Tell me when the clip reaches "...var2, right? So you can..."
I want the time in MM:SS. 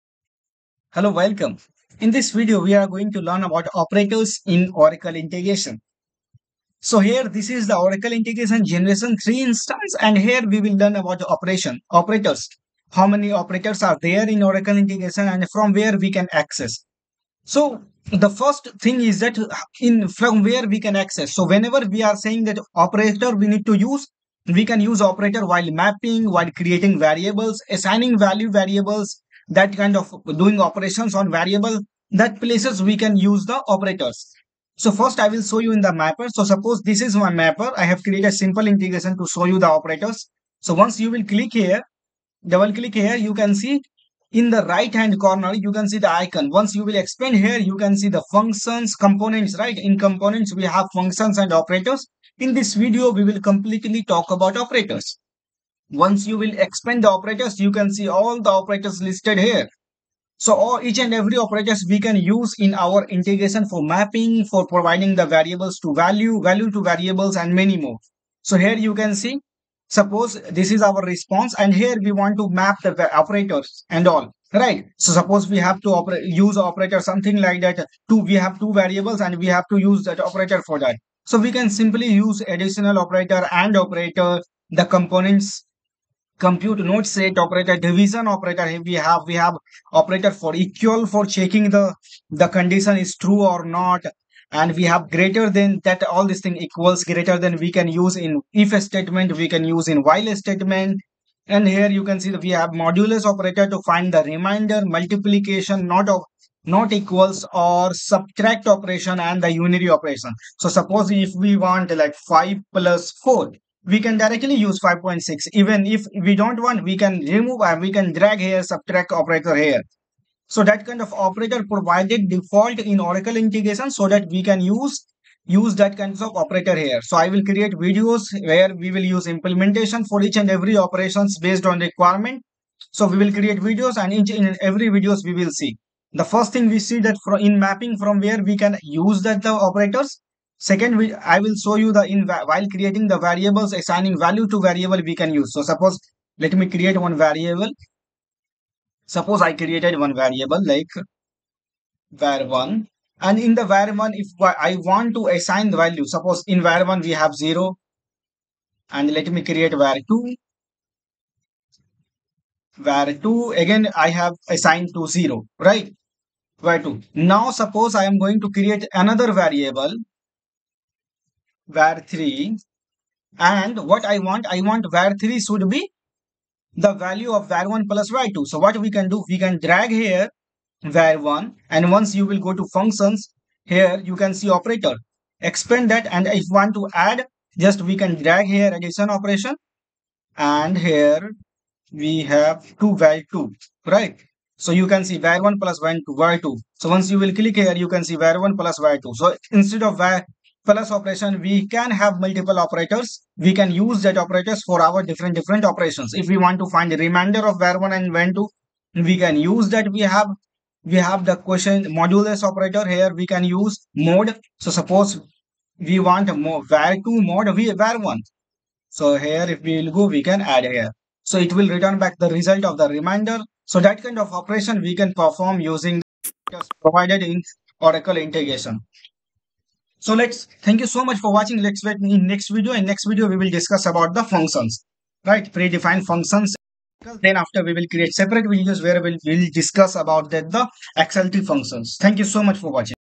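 03:12.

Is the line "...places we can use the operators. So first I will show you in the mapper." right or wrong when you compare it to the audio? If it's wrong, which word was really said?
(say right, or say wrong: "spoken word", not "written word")
right.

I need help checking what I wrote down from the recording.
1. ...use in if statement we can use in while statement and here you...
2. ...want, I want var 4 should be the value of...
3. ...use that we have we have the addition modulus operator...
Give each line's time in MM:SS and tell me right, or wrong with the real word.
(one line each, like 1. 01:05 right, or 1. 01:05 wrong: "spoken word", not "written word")
1. 01:37 right
2. 02:54 wrong: "3", not "4"
3. 03:29 wrong: "question", not "addition".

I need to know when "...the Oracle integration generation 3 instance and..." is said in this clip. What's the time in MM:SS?
00:07.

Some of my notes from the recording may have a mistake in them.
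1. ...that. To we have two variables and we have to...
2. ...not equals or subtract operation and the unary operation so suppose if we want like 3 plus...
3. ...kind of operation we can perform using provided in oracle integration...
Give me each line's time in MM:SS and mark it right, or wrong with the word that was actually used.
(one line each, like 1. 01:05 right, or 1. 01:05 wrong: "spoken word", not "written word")
1. 01:17 right
2. 01:46 wrong: "5", not "3"
3. 03:44 right.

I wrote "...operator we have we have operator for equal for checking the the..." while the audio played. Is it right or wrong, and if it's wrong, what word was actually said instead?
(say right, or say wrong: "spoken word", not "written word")
right.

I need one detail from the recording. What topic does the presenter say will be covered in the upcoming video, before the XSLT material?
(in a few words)
Predefined functions.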